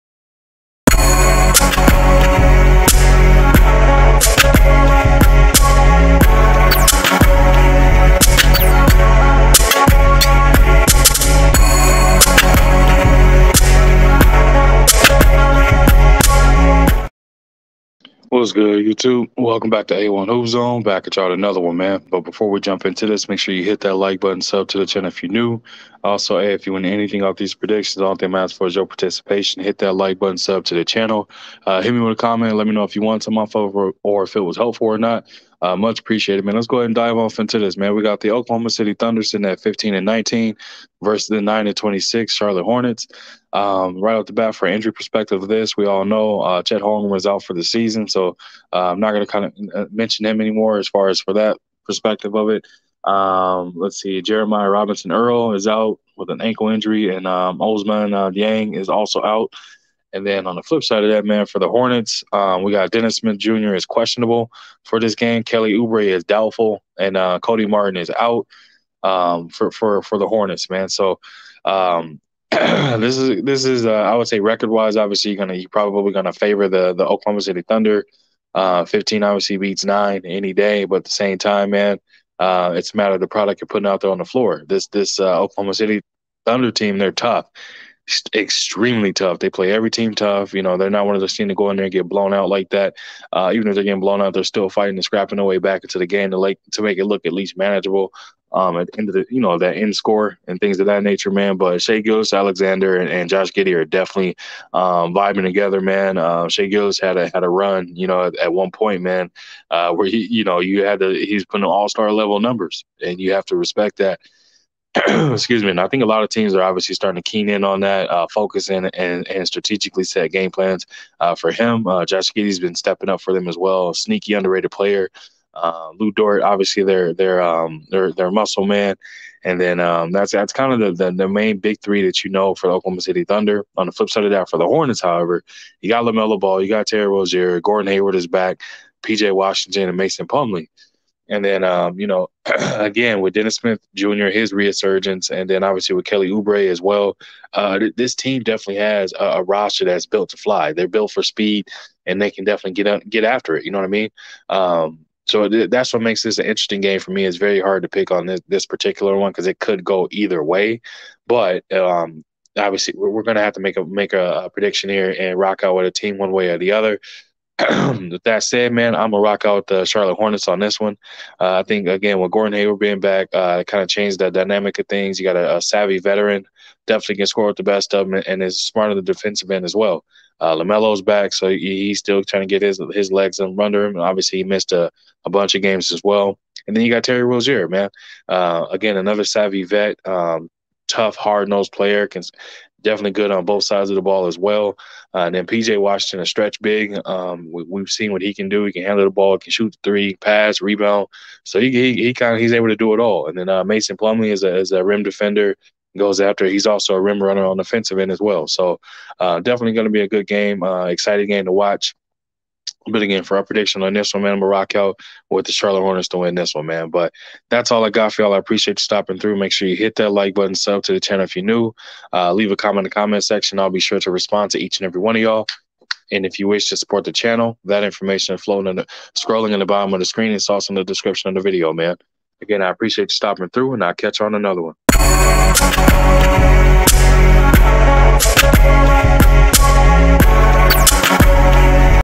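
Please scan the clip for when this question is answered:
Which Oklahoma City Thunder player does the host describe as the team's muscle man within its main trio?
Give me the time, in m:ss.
2:05.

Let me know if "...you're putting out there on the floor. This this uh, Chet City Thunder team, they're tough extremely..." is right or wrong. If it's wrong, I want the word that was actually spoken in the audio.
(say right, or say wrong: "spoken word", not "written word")
wrong: "Oklahoma", not "Chet".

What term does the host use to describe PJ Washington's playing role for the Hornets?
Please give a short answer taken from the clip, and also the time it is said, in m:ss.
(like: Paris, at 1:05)
stretch big, at 3:16.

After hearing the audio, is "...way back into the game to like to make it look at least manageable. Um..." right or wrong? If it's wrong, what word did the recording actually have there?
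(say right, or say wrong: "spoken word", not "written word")
right.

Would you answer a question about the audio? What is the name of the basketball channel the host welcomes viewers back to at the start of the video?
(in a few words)
A1 Hoop Zone.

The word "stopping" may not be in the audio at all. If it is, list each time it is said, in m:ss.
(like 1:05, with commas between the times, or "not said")
3:38, 3:53.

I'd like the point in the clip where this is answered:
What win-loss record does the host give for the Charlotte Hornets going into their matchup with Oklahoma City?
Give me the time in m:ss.
0:41.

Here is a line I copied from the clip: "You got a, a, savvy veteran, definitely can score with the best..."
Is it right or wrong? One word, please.
right.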